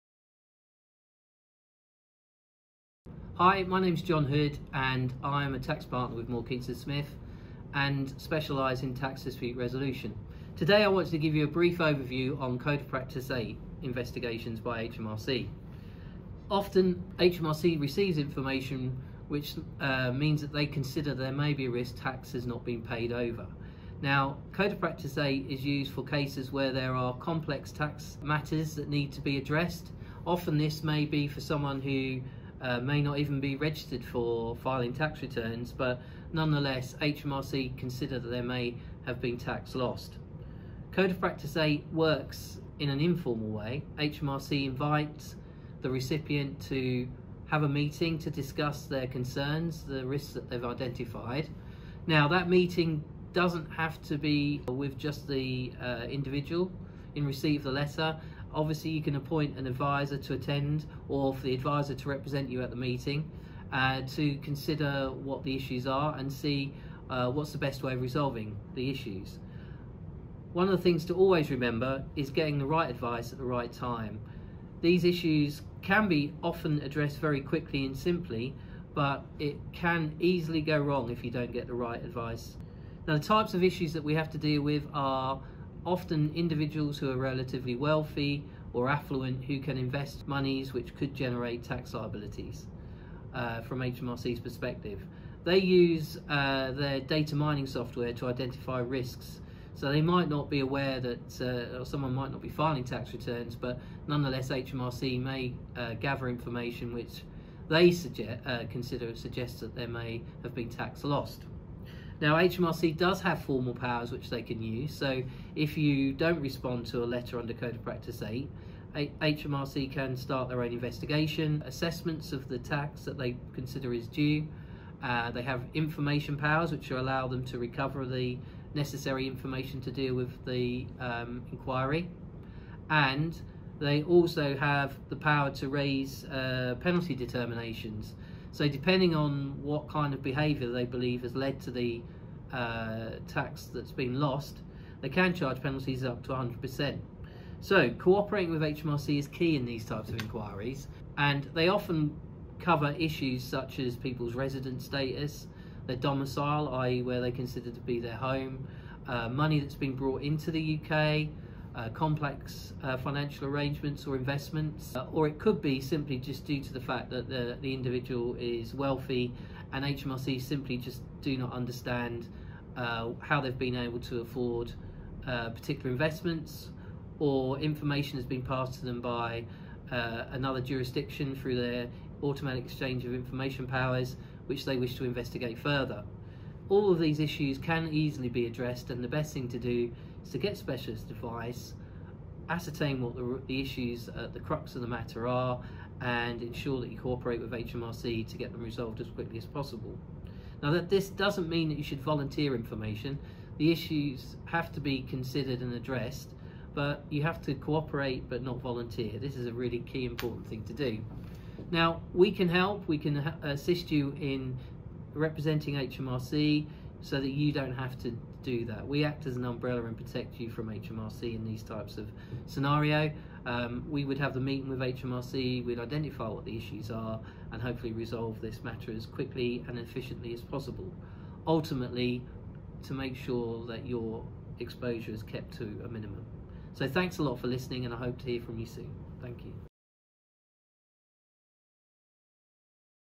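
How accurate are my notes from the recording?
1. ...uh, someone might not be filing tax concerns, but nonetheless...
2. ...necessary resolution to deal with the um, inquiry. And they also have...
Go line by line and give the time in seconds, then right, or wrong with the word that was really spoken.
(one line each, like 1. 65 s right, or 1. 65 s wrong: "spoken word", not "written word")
1. 101 s wrong: "returns", not "concerns"
2. 128 s wrong: "information", not "resolution".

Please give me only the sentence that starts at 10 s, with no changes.
Today I want to give you a brief overview on Code of Practice 8 investigations by HMRC.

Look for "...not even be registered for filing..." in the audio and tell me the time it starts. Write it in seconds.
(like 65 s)
33 s.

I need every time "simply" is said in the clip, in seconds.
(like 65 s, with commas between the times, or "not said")
77 s, 165 s, 170 s.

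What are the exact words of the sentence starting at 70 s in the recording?
One of the things to always remember is getting the right advice at the right time.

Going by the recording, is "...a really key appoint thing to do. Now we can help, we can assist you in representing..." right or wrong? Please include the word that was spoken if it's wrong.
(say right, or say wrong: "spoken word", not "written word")
wrong: "important", not "appoint".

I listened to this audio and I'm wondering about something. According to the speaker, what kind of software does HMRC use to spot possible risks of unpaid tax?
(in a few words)
Data mining software.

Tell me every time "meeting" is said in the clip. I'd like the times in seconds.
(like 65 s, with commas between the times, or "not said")
47 s, 52 s, 62 s, 224 s.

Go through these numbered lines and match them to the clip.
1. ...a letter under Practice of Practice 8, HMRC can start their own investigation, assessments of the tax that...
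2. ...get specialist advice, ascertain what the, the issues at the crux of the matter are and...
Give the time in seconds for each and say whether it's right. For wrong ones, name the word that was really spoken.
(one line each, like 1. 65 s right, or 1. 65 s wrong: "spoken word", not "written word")
1. 117 s wrong: "Code", not "Practice"
2. 190 s right.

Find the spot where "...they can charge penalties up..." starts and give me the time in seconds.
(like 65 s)
144 s.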